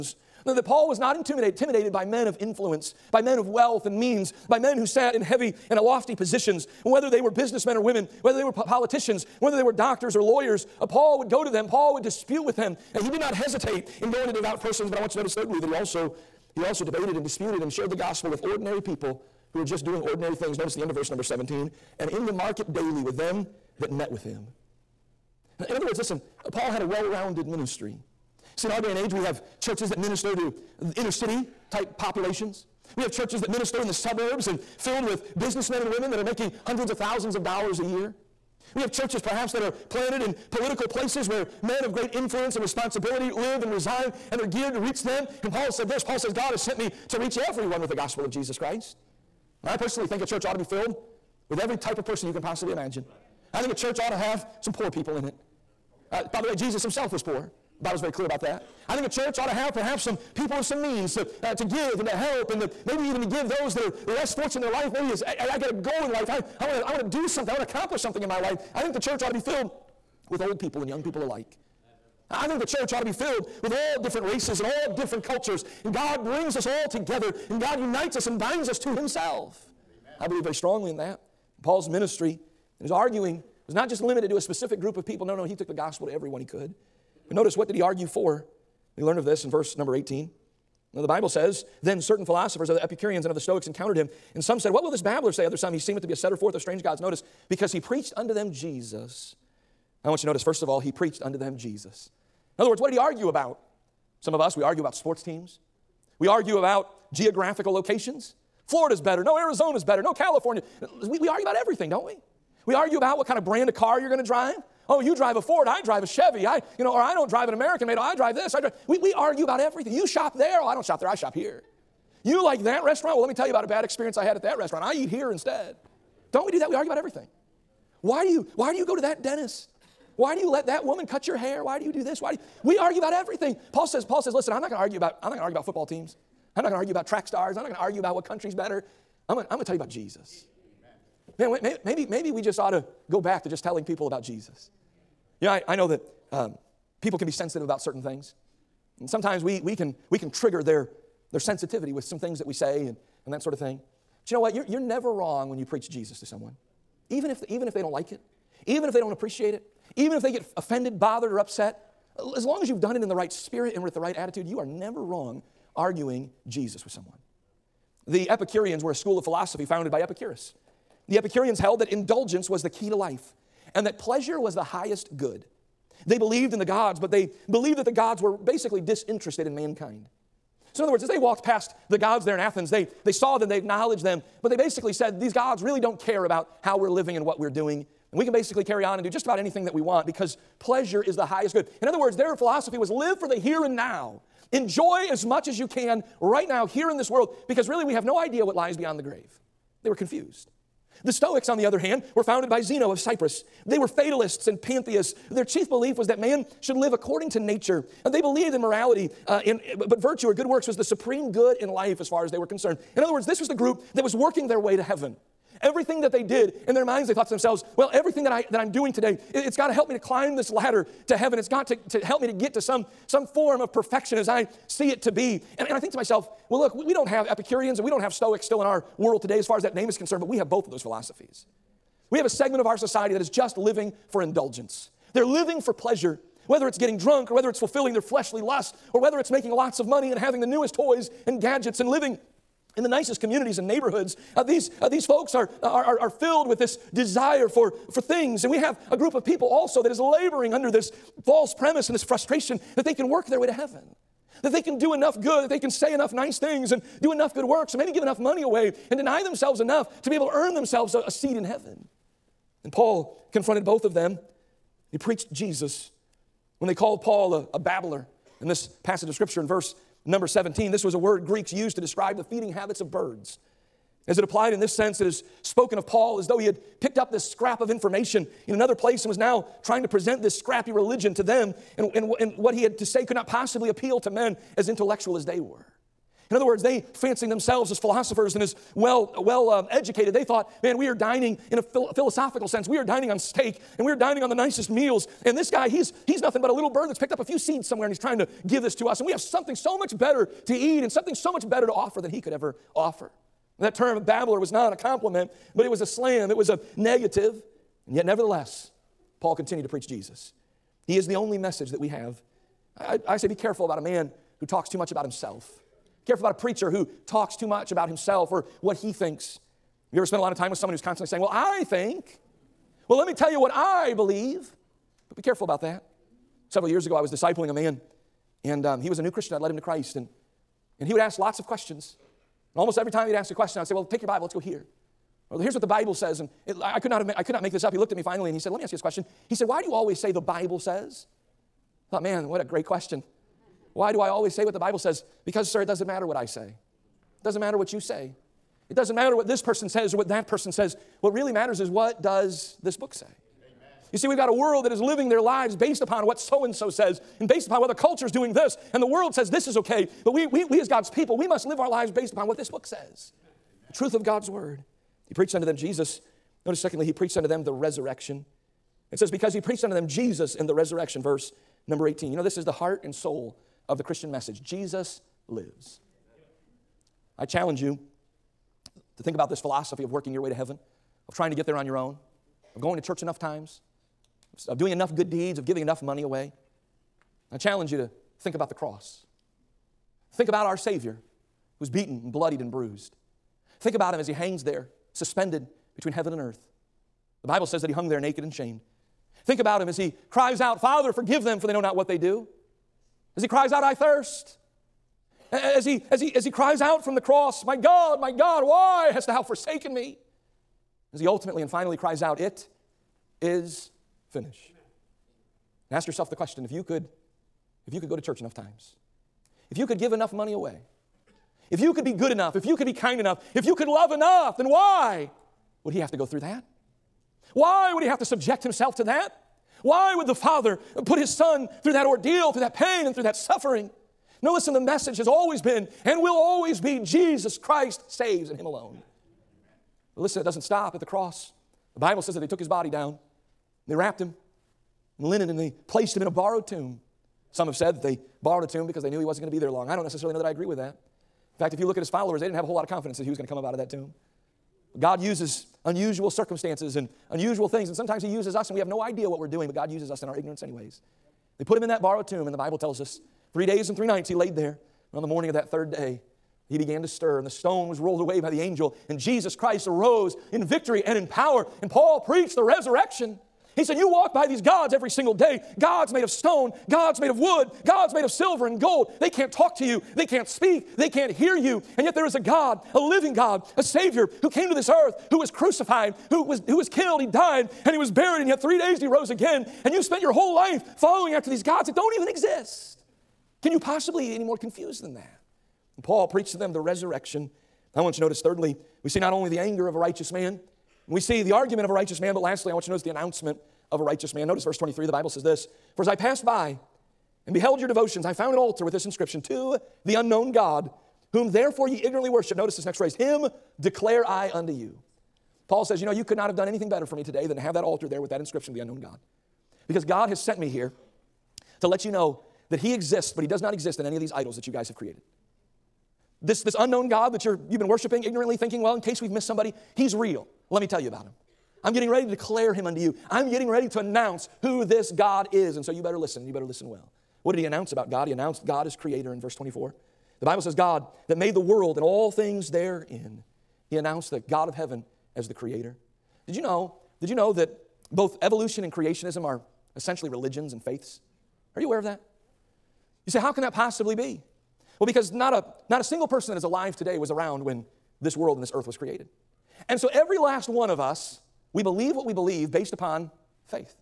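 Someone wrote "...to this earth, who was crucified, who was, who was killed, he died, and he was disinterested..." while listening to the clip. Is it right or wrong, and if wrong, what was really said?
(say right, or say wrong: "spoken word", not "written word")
wrong: "buried", not "disinterested".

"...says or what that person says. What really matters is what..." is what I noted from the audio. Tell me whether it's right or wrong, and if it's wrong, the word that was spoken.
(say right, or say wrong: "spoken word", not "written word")
right.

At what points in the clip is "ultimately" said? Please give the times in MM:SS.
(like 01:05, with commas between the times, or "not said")
06:51.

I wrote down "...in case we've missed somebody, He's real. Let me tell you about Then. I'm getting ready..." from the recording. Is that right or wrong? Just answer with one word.
wrong.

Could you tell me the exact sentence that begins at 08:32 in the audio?
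Notice this next phrase Him declare I unto you.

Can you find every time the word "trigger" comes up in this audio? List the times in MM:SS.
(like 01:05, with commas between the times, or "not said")
02:30.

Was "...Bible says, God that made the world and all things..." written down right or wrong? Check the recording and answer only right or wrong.
right.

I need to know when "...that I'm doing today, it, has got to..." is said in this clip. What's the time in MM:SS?
03:38.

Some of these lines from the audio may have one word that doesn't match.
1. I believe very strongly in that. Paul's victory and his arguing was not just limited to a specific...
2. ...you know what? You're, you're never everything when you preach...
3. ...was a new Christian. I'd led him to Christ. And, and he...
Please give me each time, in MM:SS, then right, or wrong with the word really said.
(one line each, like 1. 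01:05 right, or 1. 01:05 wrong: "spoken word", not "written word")
1. 01:20 wrong: "ministry", not "victory"
2. 02:34 wrong: "wrong", not "everything"
3. 05:28 right.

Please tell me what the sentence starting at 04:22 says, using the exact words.
And Paul confronted both of them.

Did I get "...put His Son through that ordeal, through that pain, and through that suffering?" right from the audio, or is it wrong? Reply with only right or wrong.
right.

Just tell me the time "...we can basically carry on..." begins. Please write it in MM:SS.
03:08.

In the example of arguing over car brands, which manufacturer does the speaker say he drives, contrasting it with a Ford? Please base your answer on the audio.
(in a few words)
Chevy.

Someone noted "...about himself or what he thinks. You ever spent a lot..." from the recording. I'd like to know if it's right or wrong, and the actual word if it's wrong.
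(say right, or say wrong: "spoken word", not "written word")
right.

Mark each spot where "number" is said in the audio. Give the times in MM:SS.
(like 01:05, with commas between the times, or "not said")
00:21, 01:29, 04:30, 06:11.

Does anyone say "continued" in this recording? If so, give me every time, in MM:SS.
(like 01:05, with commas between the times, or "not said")
05:09.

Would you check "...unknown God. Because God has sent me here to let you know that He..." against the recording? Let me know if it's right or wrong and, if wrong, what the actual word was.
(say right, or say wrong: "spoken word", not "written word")
right.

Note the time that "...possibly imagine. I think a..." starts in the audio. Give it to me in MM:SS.
00:52.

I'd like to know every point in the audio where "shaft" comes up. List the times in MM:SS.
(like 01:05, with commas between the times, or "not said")
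not said.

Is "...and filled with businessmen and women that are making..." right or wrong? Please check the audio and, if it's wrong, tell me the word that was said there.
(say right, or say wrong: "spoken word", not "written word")
right.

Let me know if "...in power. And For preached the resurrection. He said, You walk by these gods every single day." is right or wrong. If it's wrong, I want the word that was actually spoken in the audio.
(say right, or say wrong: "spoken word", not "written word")
wrong: "Paul", not "For".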